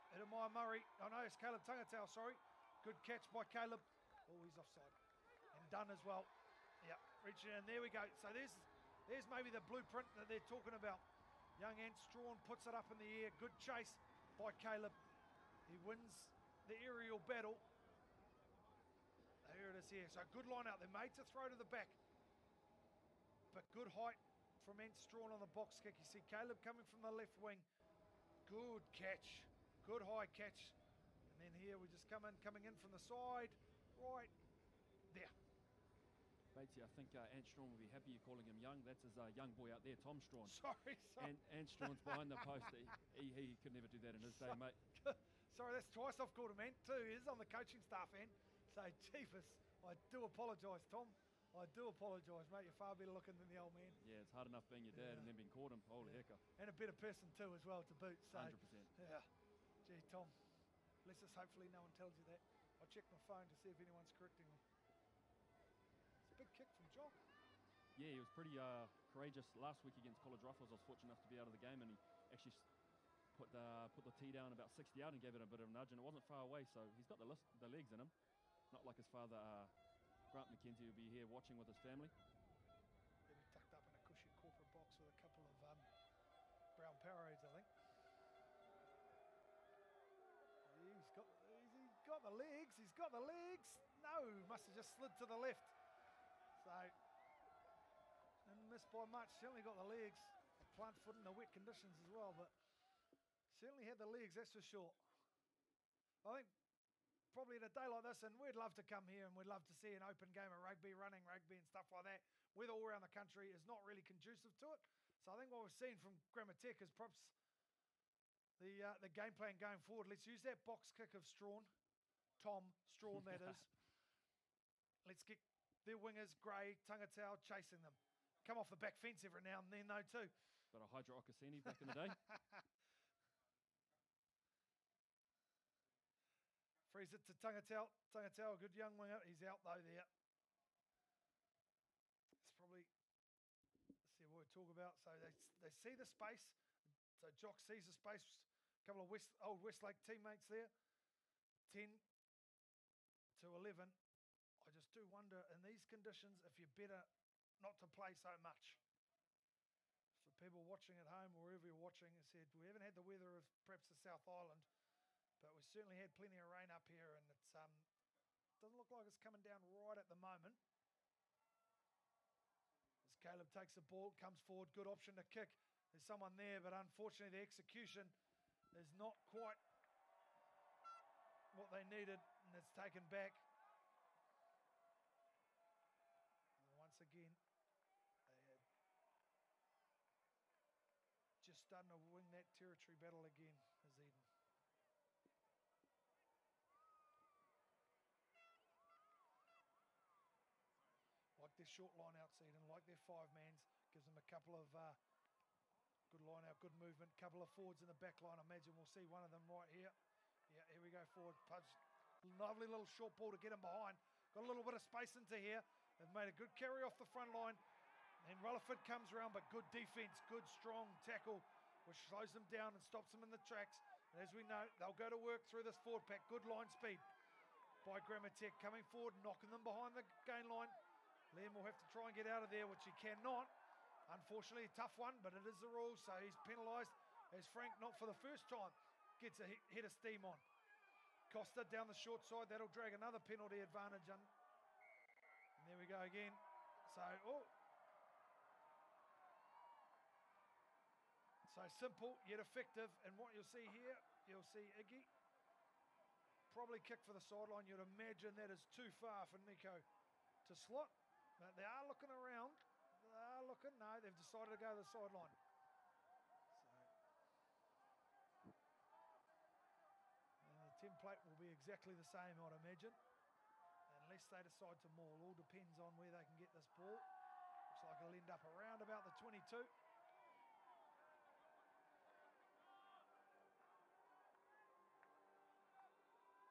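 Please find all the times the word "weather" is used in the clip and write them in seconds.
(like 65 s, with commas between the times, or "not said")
112 s, 163 s.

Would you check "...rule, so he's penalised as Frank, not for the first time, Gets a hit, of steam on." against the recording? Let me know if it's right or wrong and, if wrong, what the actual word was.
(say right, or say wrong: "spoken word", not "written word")
right.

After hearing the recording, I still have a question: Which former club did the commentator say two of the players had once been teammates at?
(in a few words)
Westlake.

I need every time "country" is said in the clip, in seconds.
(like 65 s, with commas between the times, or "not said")
113 s.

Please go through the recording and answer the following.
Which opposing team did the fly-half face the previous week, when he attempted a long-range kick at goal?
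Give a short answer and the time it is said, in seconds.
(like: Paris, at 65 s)
College Rifles, at 70 s.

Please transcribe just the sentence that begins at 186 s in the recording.
And once again, they had just starting to win that territory battle again, as Eden.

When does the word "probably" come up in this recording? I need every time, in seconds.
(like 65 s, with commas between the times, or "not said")
107 s, 142 s, 256 s.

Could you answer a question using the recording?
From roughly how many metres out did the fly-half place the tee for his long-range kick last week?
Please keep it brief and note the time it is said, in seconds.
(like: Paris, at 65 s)
60, at 74 s.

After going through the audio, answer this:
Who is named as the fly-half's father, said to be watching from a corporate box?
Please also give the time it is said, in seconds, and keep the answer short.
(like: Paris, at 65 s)
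Grant McKenzie, at 80 s.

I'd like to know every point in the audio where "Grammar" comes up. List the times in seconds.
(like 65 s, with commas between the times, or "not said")
116 s, 227 s.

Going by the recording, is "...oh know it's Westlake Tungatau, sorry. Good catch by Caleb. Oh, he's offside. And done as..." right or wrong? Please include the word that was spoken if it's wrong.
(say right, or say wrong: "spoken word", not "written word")
wrong: "Caleb", not "Westlake".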